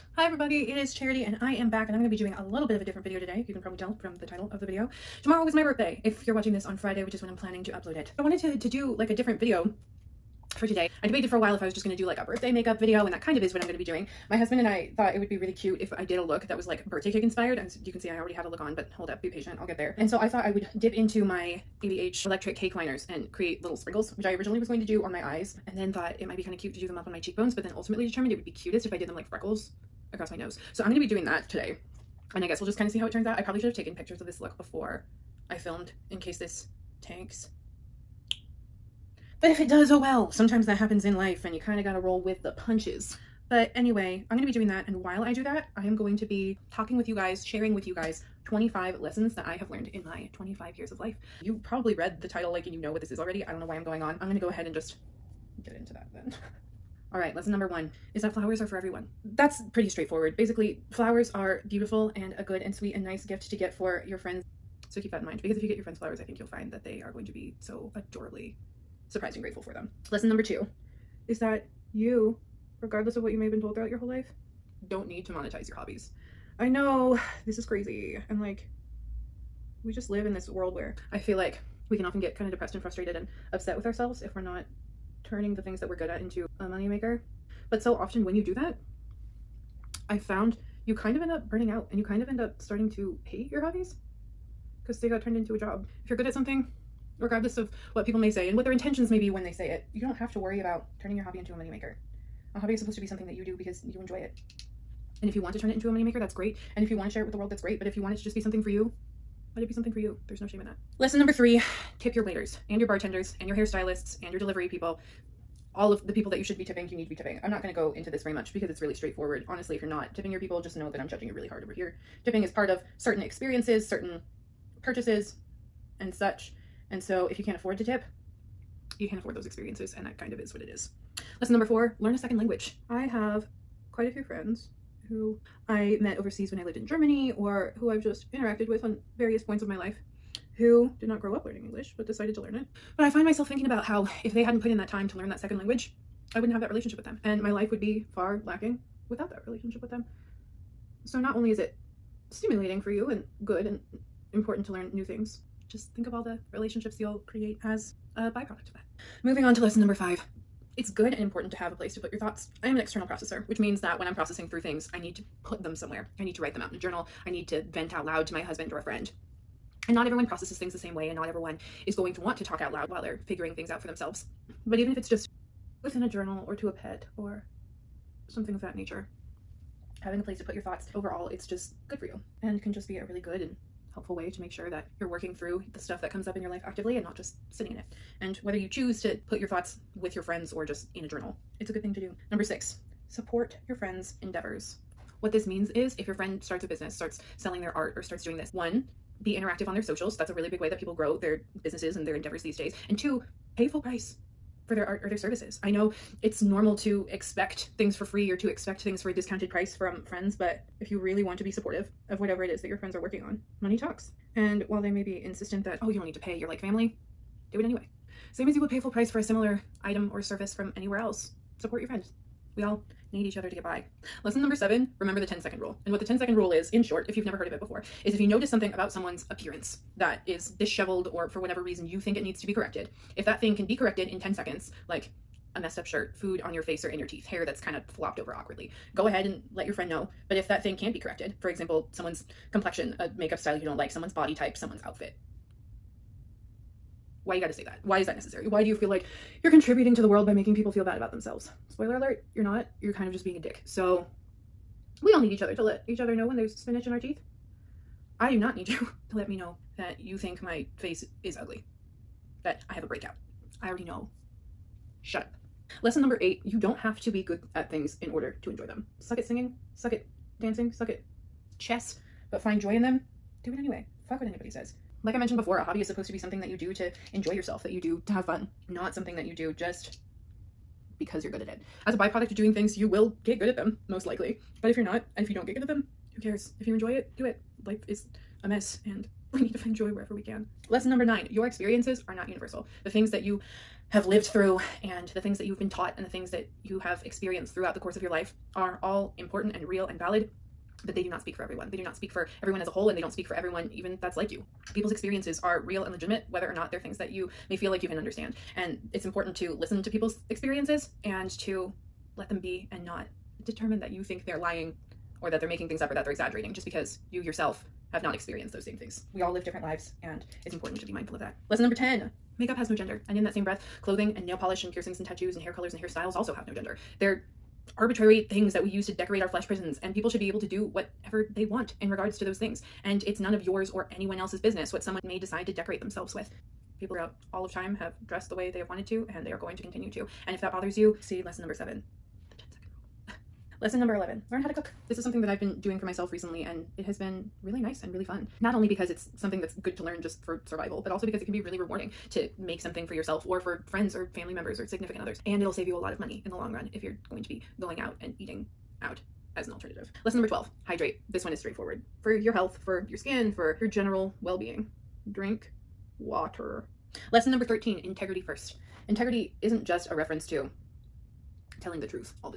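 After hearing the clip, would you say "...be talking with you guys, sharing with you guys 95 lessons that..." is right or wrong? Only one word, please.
wrong.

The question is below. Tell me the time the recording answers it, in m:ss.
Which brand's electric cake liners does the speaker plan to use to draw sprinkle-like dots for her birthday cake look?
0:21.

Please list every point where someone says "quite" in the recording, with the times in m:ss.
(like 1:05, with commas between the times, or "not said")
2:13.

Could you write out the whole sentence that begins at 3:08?
And whether you choose to put your thoughts with your friends or just in a journal, it's a good thing to do.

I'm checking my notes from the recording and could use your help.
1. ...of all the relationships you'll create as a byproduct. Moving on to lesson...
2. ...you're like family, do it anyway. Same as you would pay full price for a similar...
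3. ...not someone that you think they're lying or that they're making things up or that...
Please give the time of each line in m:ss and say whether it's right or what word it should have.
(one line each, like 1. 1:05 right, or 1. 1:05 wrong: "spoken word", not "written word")
1. 2:36 right
2. 3:36 right
3. 5:12 wrong: "determine", not "someone".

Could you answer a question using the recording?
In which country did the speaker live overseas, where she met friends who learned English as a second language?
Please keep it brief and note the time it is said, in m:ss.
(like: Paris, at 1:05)
Germany, at 2:16.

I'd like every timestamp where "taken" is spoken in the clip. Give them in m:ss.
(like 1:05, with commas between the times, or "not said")
0:33.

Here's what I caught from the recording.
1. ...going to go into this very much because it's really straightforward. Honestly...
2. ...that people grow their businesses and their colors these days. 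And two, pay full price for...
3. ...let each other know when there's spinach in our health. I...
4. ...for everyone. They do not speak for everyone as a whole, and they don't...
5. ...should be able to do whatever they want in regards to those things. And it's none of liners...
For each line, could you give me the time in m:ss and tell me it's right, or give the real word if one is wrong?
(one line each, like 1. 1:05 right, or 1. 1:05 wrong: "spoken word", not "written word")
1. 1:57 right
2. 3:20 wrong: "endeavors", not "colors"
3. 4:15 wrong: "teeth", not "health"
4. 5:01 right
5. 5:30 wrong: "yours", not "liners".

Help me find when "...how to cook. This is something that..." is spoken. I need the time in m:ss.
5:44.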